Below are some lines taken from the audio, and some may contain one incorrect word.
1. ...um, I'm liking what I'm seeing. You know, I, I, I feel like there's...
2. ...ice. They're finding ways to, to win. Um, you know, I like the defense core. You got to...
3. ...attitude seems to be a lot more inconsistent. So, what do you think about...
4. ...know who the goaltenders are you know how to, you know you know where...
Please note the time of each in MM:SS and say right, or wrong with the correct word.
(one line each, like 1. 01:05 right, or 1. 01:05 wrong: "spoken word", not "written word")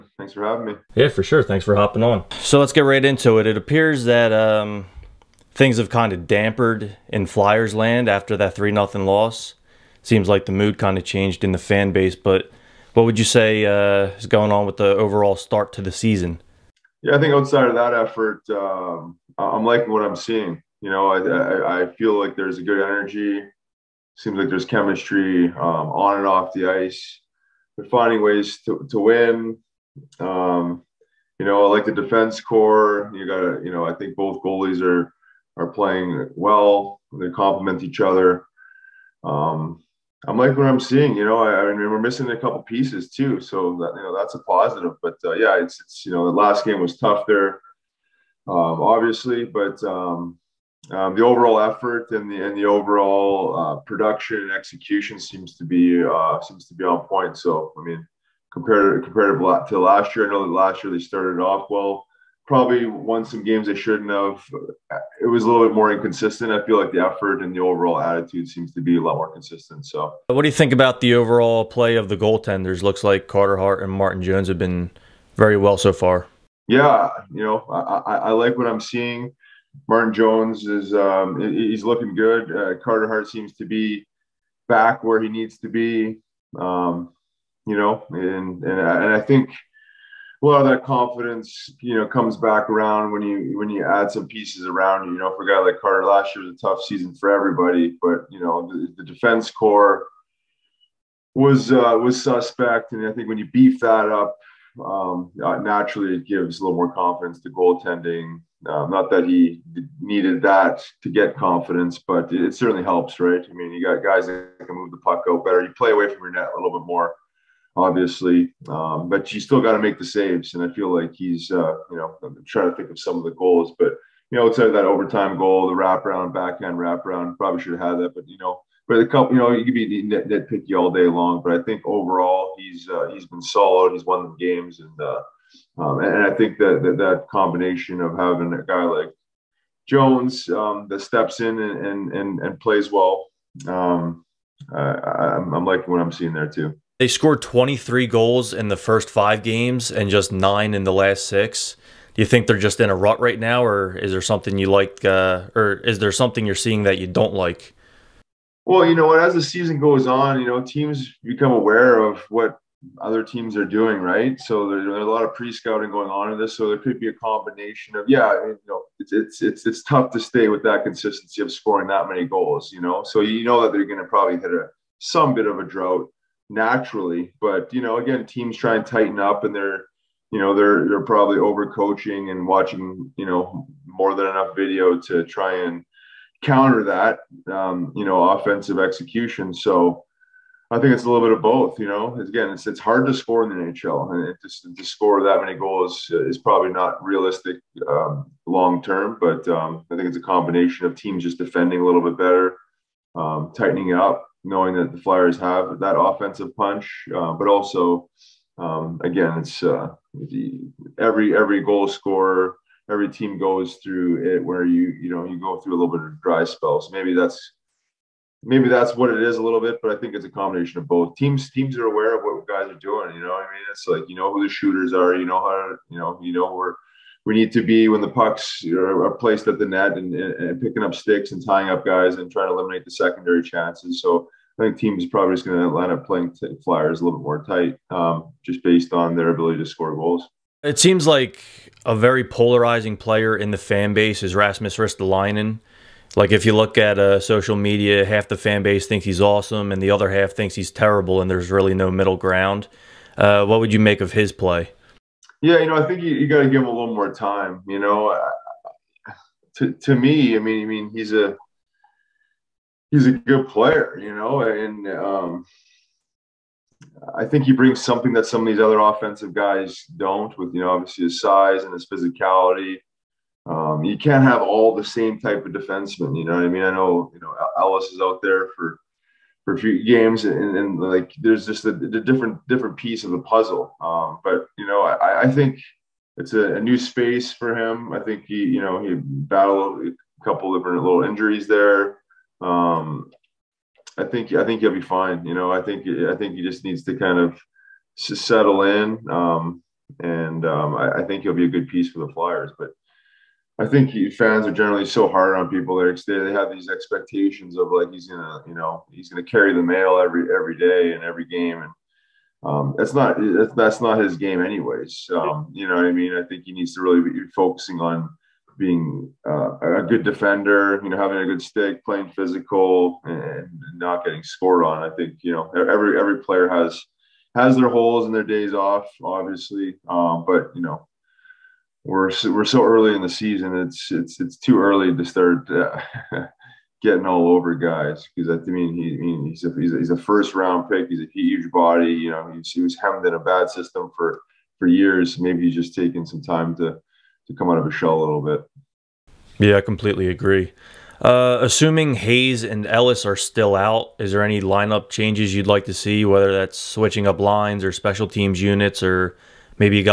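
1. 00:18 right
2. 00:26 right
3. 01:07 wrong: "consistent", not "inconsistent"
4. 03:44 wrong: "shooters", not "goaltenders".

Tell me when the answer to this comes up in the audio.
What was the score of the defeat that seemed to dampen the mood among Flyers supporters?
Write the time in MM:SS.
00:08.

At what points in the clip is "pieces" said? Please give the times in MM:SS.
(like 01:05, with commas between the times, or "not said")
00:42, 01:34, 04:42, 05:01.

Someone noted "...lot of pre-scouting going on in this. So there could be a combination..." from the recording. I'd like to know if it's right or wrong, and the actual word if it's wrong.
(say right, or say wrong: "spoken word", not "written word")
right.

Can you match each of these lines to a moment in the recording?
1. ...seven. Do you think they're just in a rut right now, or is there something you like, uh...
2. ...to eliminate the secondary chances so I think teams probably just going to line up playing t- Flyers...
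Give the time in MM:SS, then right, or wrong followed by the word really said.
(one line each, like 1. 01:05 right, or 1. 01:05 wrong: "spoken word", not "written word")
1. 02:31 wrong: "six", not "seven"
2. 03:52 right.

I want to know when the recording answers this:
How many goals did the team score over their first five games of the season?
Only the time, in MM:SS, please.
02:27.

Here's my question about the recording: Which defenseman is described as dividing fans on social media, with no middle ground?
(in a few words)
Rasmus Ristolainen.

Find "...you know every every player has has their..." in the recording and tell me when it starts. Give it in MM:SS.
05:25.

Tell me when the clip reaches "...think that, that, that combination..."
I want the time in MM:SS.
02:16.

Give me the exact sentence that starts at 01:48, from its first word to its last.
Um, not that he needed that to get confidence, but it certainly helps, right?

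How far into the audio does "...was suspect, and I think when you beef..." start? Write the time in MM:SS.
01:41.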